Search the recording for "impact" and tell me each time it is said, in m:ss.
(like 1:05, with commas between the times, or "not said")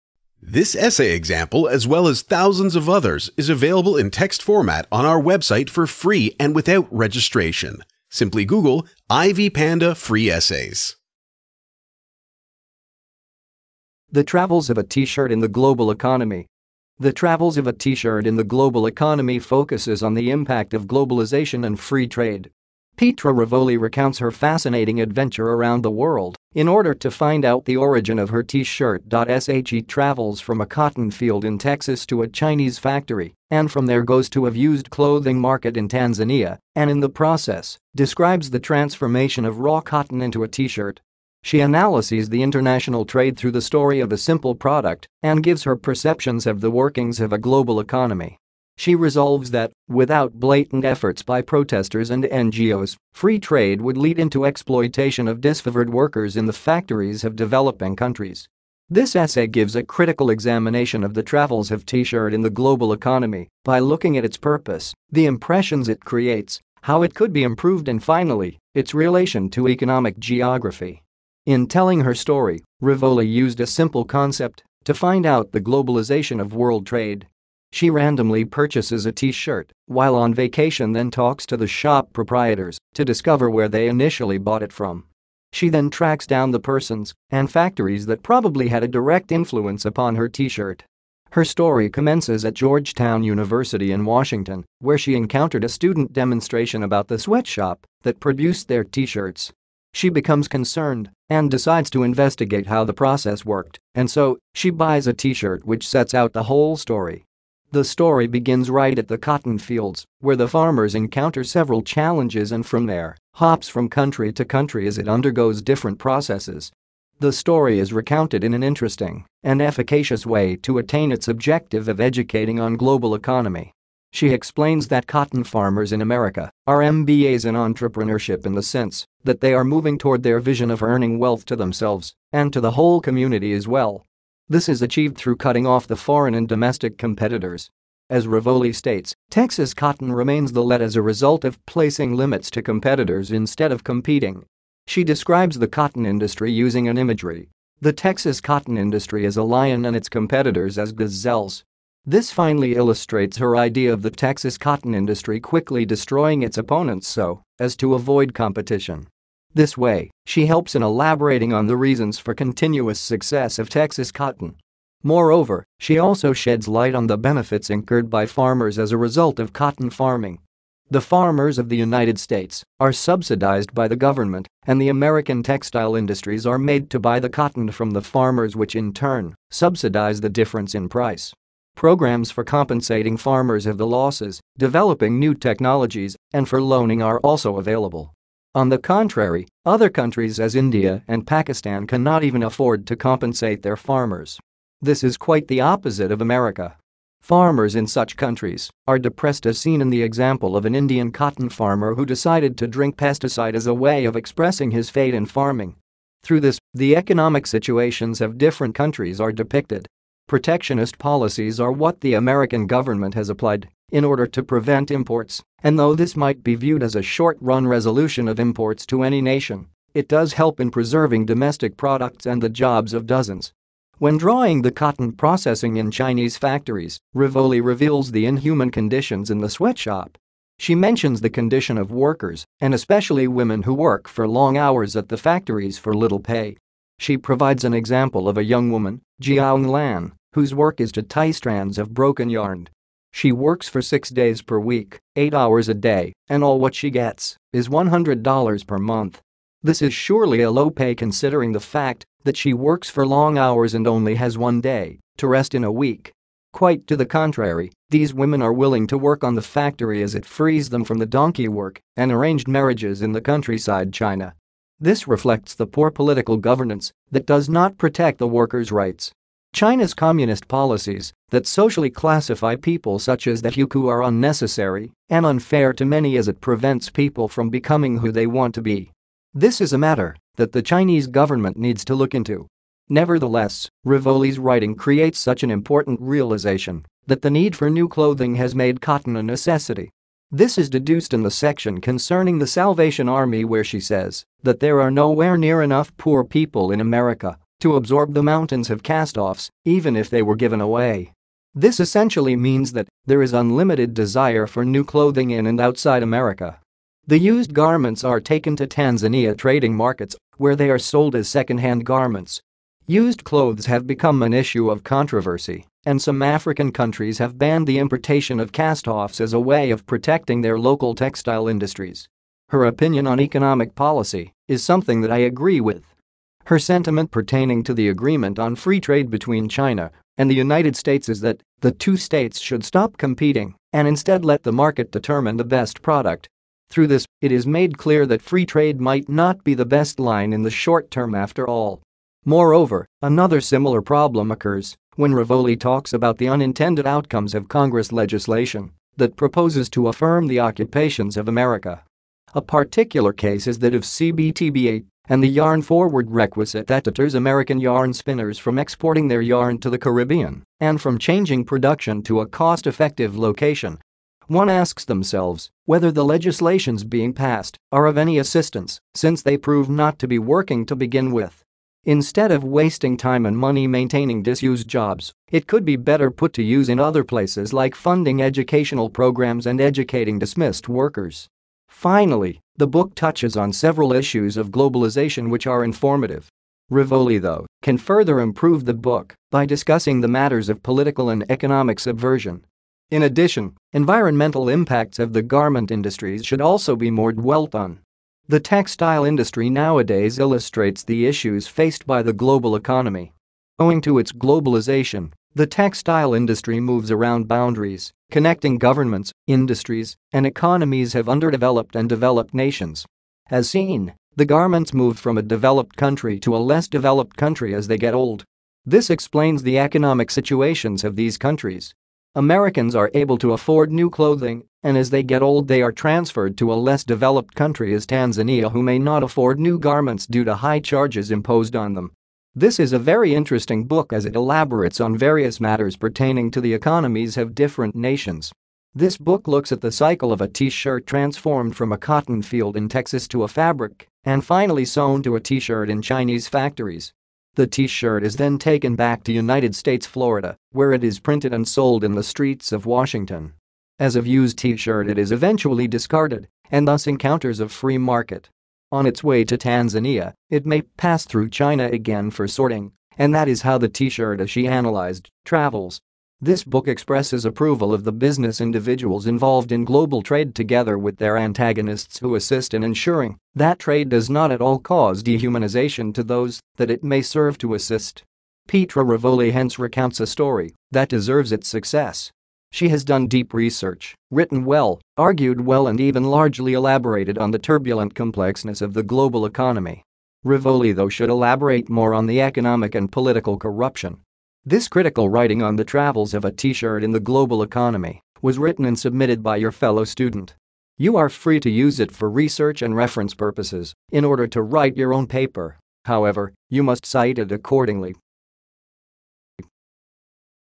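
0:20, 6:34.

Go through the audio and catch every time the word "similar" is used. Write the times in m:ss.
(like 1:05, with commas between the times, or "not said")
5:43.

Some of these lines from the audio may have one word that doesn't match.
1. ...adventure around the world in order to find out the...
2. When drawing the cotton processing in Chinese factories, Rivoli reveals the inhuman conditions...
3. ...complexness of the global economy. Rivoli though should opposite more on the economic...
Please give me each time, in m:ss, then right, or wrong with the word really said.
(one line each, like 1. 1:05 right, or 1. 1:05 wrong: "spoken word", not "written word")
1. 0:25 right
2. 3:43 right
3. 8:07 wrong: "elaborate", not "opposite".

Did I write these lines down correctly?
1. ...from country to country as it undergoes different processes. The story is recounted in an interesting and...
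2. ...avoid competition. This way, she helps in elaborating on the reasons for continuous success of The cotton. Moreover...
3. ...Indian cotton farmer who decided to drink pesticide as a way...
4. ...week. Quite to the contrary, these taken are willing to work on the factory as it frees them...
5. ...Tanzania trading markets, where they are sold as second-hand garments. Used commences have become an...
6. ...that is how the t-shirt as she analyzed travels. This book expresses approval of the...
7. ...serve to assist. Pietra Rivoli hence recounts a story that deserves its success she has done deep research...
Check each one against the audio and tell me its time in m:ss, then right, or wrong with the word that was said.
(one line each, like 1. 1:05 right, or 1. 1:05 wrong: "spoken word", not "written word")
1. 1:53 right
2. 2:37 wrong: "Texas", not "The"
3. 3:20 right
4. 4:15 wrong: "women", not "taken"
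5. 5:08 wrong: "clothes", not "commences"
6. 7:43 right
7. 7:57 right.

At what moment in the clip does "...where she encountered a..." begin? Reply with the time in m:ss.
1:34.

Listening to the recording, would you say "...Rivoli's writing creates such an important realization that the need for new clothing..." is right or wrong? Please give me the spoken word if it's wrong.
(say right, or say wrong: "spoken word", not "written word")
right.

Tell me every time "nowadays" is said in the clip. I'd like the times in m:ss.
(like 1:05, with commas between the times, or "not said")
6:39.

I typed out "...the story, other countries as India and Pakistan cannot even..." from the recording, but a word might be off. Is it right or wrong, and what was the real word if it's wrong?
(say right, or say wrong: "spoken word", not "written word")
wrong: "contrary", not "story".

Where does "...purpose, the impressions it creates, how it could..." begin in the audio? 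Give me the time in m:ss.
1:04.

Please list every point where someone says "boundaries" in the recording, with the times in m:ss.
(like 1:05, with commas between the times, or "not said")
6:47.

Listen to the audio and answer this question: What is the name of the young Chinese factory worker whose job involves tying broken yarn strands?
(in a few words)
Jiang Lan.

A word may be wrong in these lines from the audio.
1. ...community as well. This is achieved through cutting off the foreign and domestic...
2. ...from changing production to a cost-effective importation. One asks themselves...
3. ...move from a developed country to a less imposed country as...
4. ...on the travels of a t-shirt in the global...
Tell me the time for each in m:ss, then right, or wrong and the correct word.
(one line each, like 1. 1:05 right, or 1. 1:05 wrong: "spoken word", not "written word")
1. 2:12 right
2. 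6:00 wrong: "location", not "importation"
3. 6:54 wrong: "developed", not "imposed"
4. 8:15 right.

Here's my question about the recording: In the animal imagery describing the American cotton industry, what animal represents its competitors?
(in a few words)
gazelles.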